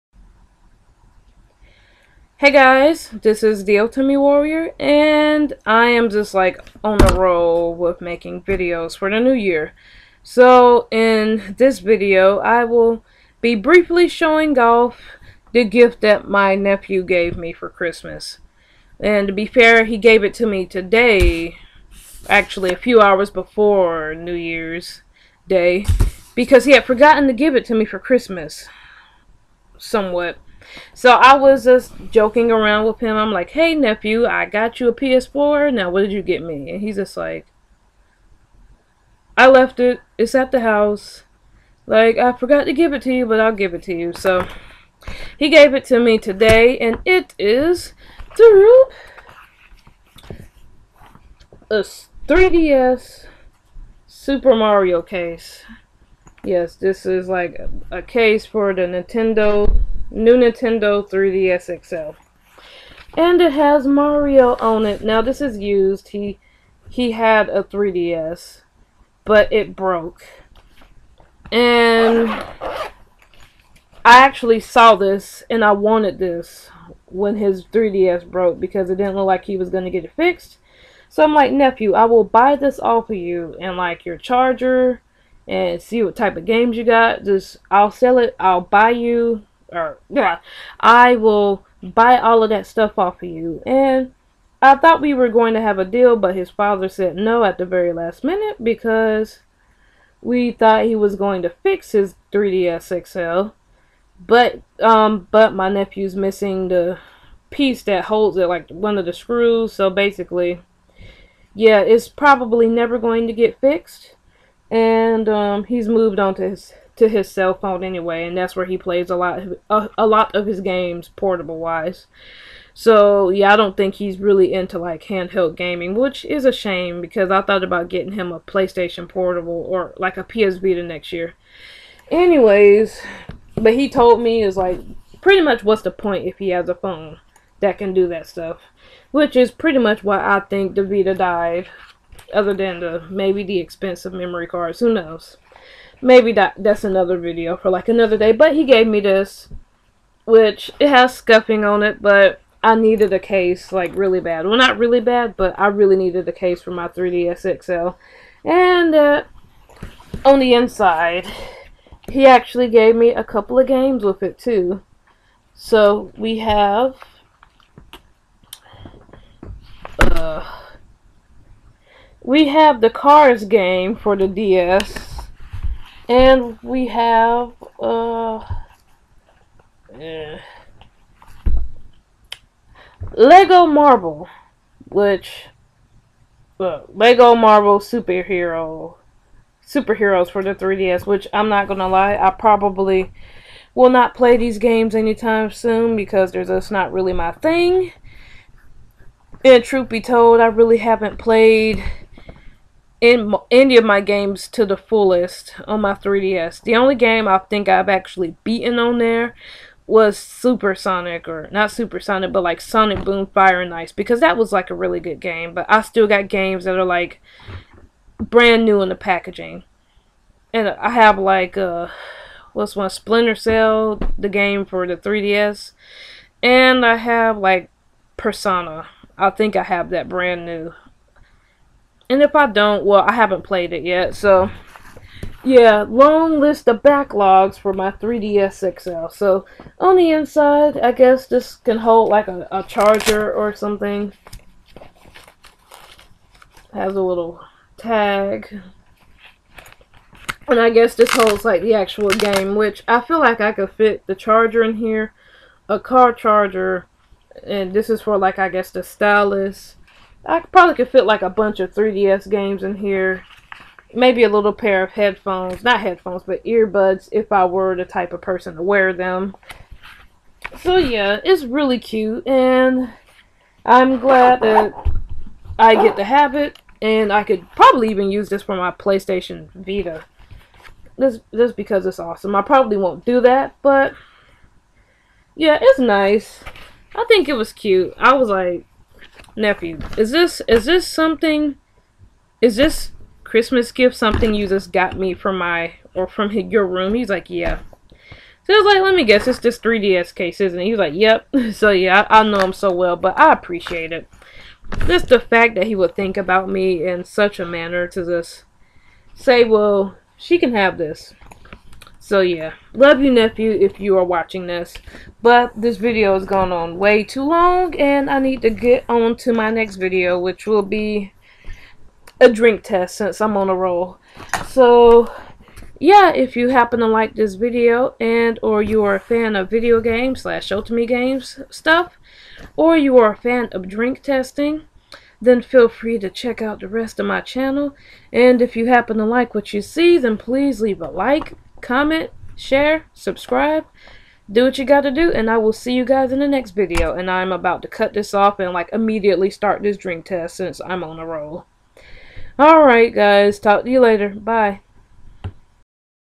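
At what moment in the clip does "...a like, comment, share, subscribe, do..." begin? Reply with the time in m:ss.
5:40.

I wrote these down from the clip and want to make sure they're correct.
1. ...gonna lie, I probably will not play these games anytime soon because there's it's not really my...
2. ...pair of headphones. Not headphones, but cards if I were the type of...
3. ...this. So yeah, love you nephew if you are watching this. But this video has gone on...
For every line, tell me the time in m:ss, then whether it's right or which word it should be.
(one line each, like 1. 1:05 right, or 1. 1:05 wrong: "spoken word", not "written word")
1. 3:11 right
2. 4:24 wrong: "earbuds", not "cards"
3. 5:10 right.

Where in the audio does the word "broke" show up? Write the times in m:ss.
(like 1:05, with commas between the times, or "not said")
1:09, 1:18.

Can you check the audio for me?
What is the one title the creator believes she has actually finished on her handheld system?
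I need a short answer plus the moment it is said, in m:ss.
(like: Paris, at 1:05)
Sonic Boom Fire and Ice, at 3:32.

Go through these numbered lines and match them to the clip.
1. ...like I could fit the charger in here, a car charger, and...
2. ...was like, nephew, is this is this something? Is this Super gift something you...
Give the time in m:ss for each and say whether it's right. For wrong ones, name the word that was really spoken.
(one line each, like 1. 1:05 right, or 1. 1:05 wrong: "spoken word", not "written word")
1. 4:13 right
2. 4:48 wrong: "Christmas", not "Super".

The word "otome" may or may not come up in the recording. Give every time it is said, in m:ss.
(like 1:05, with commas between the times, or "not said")
0:03, 5:30.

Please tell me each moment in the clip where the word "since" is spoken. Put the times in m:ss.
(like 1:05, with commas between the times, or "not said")
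5:22, 5:50.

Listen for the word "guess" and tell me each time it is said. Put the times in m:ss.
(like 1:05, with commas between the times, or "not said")
4:00, 4:10, 4:18, 4:59.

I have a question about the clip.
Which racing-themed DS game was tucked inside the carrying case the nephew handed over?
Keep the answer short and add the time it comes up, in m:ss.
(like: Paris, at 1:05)
Cars, at 2:52.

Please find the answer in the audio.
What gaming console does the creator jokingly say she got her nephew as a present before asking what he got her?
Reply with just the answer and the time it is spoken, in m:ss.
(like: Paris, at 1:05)
PS4, at 0:34.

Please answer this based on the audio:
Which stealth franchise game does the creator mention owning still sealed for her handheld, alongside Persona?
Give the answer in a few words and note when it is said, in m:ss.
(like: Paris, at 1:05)
Splinter Cell, at 3:42.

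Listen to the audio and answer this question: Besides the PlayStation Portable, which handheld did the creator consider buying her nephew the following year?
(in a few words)
PS Vita.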